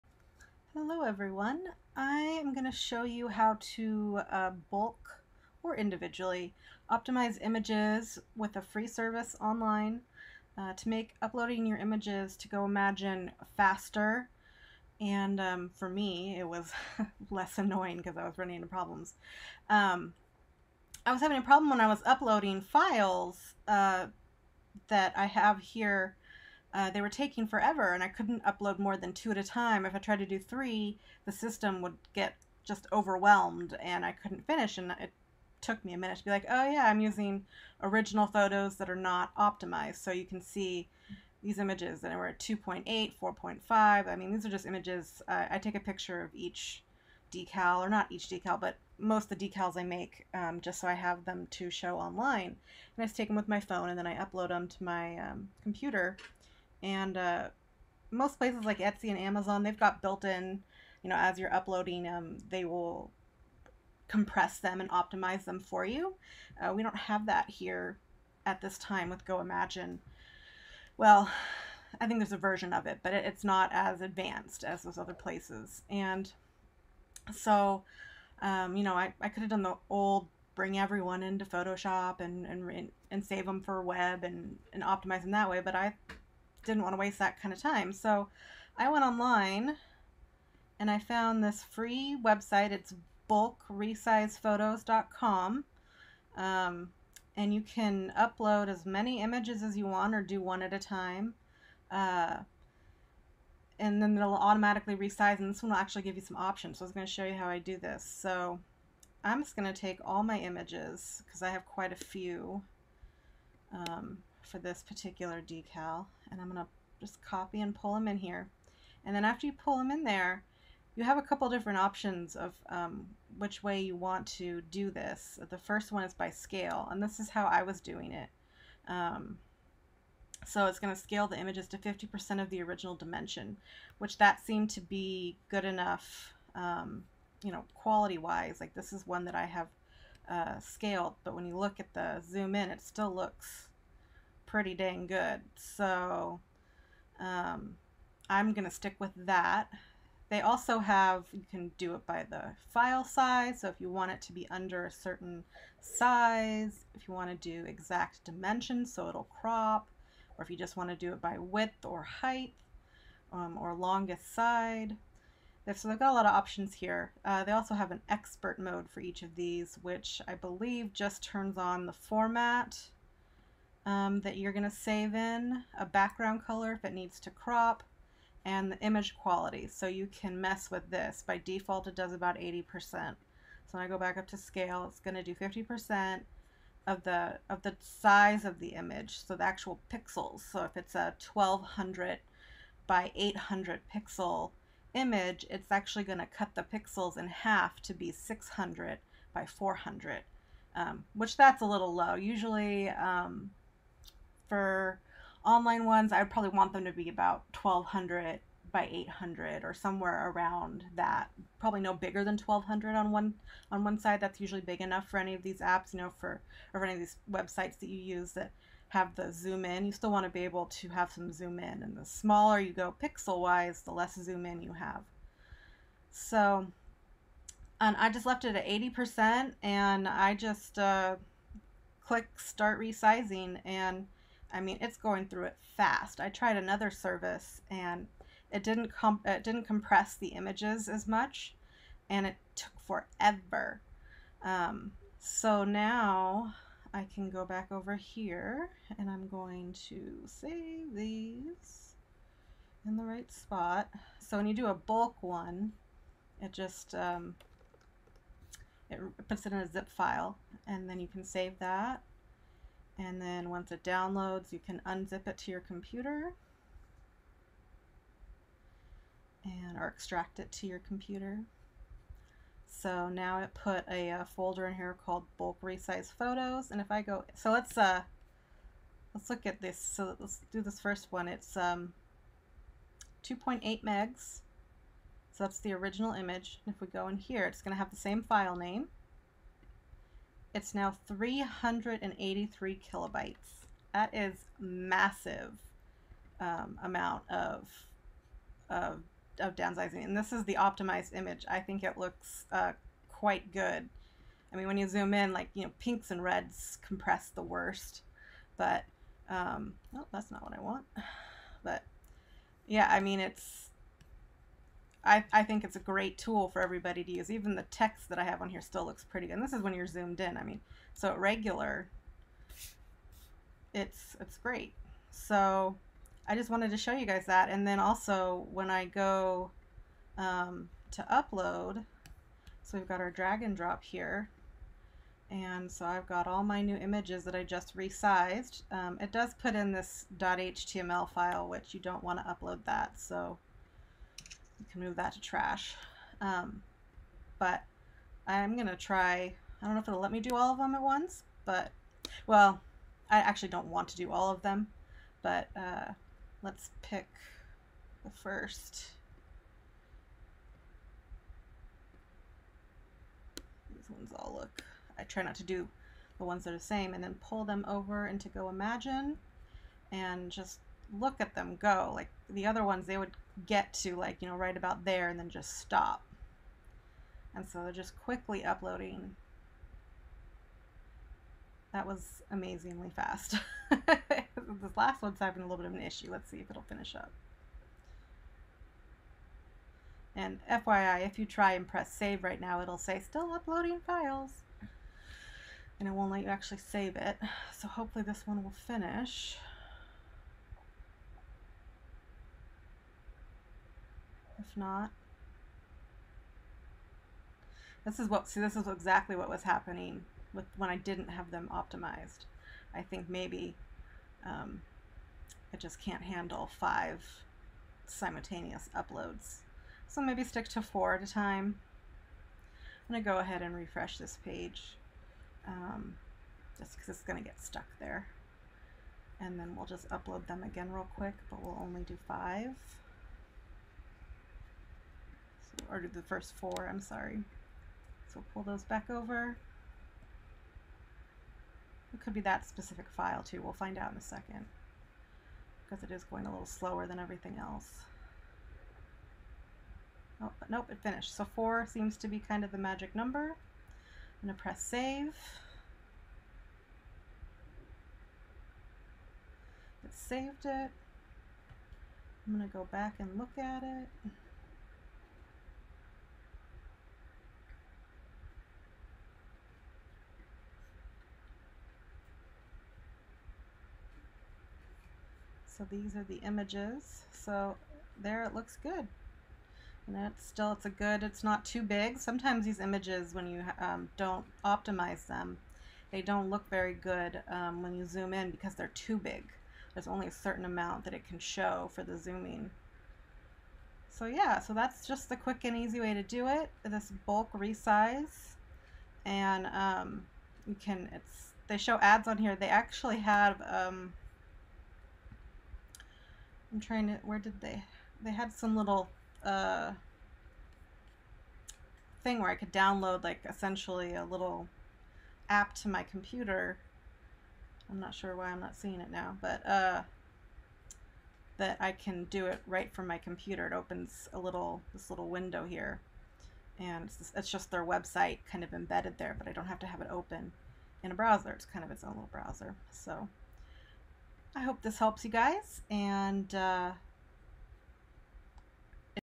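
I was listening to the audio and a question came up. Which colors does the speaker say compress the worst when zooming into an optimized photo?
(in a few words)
pinks and reds.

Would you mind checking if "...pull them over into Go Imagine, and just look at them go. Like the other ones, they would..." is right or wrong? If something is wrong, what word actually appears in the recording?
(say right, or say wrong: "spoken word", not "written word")
right.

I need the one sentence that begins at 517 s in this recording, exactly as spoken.
I'm not sure why I'm not seeing it now, but uh, that I can do it right from my computer.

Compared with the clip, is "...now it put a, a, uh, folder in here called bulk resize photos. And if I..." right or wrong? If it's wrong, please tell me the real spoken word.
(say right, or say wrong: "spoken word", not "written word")
right.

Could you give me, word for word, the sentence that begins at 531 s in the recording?
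It's kind of its own little browser.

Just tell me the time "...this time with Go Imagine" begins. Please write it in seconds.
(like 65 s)
68 s.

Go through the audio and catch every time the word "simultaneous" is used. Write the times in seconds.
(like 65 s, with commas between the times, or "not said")
417 s.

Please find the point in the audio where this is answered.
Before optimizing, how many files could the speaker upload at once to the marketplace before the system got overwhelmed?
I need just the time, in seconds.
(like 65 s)
29 s.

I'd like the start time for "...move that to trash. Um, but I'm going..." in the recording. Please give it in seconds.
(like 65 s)
344 s.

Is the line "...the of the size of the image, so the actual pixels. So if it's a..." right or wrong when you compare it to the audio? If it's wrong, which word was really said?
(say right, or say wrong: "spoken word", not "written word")
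right.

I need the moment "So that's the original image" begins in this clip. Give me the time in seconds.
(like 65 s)
285 s.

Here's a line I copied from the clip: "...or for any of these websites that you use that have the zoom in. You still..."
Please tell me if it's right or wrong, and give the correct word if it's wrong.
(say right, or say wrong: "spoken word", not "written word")
right.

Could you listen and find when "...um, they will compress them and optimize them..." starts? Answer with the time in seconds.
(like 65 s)
62 s.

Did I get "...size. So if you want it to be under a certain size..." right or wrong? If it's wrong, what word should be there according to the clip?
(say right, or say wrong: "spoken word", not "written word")
right.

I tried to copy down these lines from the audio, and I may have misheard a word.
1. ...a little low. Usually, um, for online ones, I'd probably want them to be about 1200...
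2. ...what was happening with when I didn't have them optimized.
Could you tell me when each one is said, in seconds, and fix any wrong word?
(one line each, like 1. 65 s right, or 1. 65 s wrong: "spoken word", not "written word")
1. 201 s right
2. 409 s right.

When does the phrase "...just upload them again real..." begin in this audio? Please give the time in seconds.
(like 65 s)
429 s.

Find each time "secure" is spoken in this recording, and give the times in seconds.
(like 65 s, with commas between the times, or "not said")
not said.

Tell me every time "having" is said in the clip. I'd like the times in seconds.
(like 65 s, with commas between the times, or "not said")
21 s, 385 s.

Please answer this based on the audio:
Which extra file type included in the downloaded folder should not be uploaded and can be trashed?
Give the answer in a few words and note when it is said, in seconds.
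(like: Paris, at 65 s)
.html, at 340 s.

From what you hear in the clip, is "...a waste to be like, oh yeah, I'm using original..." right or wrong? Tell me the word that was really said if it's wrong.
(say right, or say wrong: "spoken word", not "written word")
wrong: "minute", not "waste".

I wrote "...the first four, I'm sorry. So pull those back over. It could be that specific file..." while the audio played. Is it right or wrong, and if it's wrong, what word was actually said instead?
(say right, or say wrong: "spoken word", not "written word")
right.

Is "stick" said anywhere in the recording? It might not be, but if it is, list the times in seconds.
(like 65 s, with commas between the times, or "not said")
148 s, 420 s.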